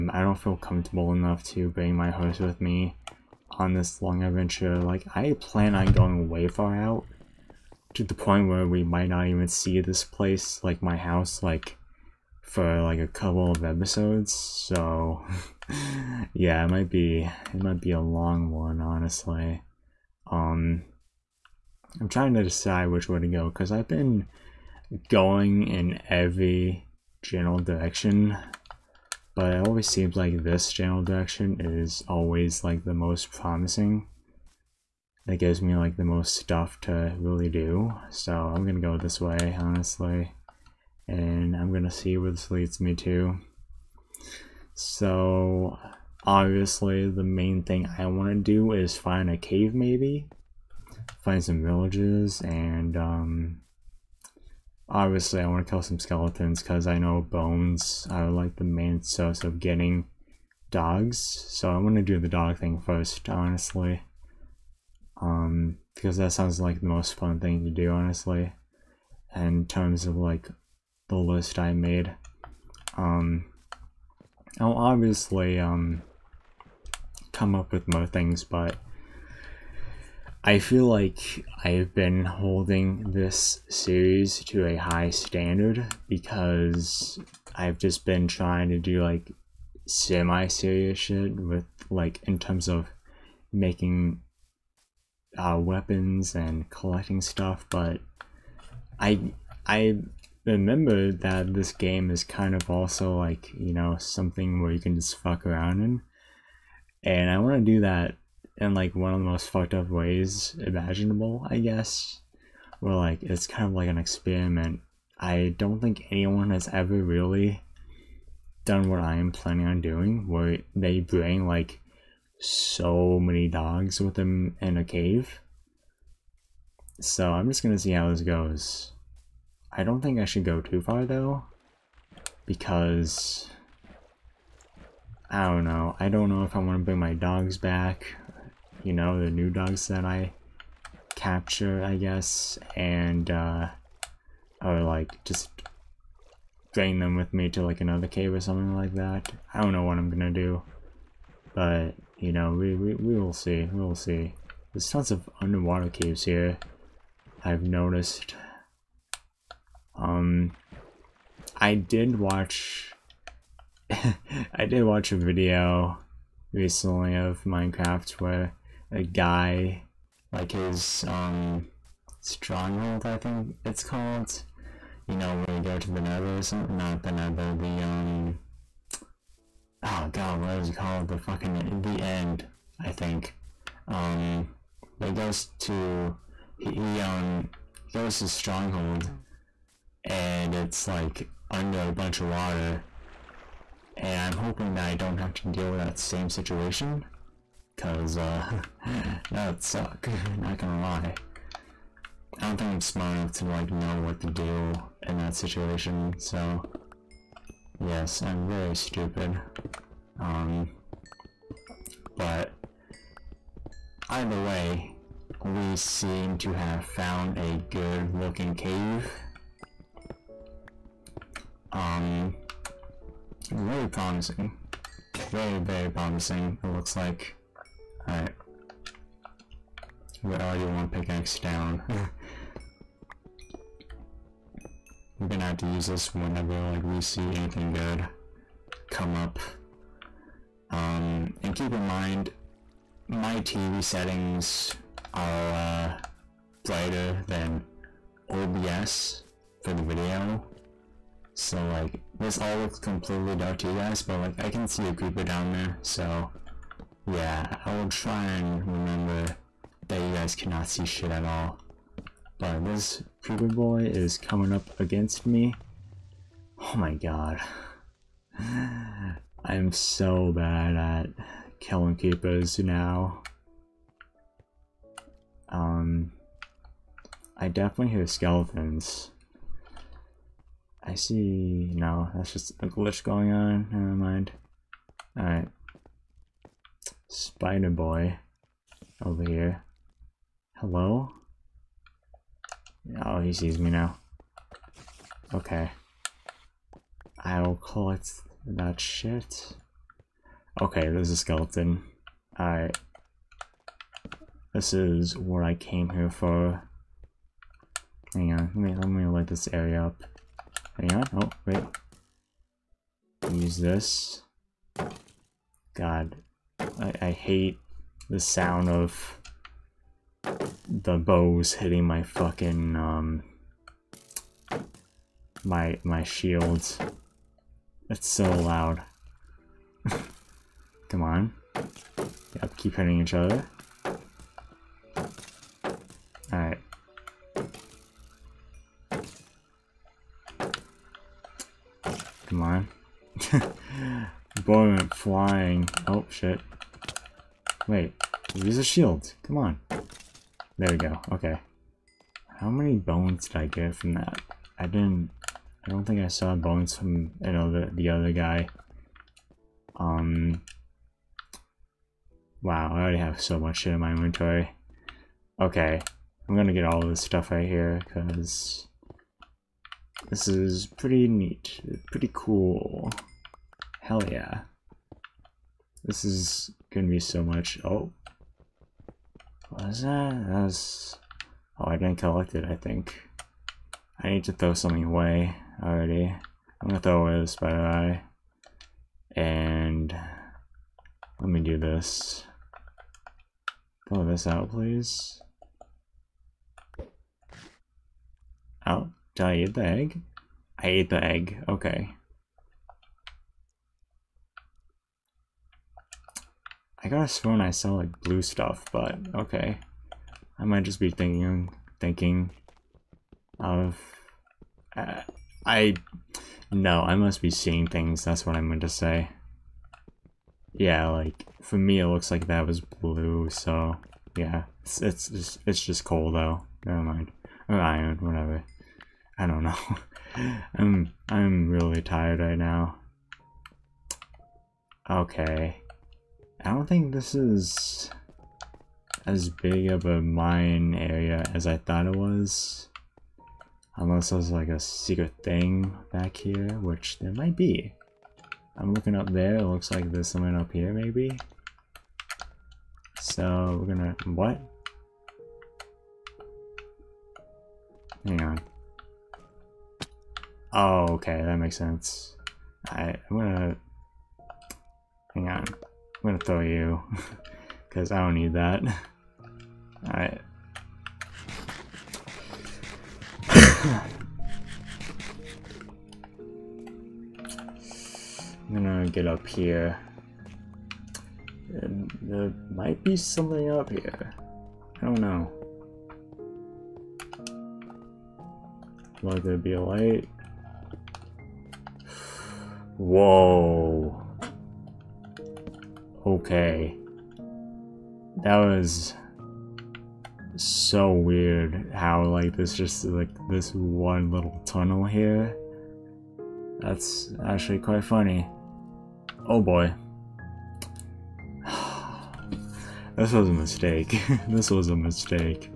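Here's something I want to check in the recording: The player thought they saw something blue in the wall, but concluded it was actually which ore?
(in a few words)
Coal.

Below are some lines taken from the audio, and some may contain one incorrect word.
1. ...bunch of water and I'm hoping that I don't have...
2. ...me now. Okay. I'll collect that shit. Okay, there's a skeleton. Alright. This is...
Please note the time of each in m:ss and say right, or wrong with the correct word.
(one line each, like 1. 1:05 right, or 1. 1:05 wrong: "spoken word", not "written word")
1. 3:11 right
2. 4:53 right.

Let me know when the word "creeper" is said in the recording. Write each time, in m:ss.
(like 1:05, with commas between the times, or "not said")
4:14, 4:23, 4:31.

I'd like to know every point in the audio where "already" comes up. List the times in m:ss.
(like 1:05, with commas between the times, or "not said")
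3:50, 6:02, 6:25.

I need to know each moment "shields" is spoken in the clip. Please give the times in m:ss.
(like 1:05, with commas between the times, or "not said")
5:26, 5:48.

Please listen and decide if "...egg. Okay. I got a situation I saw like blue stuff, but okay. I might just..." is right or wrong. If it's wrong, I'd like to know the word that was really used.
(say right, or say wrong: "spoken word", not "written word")
wrong: "swoon", not "situation".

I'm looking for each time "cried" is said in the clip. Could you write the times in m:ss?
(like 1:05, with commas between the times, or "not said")
not said.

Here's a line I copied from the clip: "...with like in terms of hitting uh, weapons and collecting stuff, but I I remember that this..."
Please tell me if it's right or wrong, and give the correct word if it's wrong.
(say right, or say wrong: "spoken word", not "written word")
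wrong: "making", not "hitting".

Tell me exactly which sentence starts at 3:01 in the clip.
The fucking, the end, I think.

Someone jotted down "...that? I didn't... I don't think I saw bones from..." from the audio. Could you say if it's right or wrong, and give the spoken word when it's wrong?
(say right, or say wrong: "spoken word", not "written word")
right.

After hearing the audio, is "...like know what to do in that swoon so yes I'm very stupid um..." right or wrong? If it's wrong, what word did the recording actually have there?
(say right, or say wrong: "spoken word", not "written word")
wrong: "situation", not "swoon".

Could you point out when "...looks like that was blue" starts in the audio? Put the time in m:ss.
7:01.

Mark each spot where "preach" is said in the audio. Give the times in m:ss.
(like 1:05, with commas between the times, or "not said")
not said.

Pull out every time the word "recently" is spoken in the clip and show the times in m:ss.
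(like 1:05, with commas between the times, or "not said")
2:46.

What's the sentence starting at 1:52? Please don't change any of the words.
Where like it's kind of like an experiment.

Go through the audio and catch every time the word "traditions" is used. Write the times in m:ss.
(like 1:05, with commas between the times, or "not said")
not said.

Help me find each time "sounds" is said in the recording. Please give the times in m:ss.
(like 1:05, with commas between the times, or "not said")
1:06, 5:18.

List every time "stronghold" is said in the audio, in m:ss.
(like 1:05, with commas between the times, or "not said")
2:52, 3:08.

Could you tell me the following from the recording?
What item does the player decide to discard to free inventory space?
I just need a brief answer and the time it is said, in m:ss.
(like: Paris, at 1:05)
Spider eye, at 6:27.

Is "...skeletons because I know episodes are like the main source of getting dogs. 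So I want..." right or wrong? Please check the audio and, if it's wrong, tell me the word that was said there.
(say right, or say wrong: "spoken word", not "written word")
wrong: "bones", not "episodes".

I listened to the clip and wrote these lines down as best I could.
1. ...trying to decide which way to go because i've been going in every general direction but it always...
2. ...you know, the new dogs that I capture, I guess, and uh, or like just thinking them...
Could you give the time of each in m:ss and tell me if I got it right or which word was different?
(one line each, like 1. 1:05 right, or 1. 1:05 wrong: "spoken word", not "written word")
1. 0:22 right
2. 2:18 wrong: "bring", not "thinking".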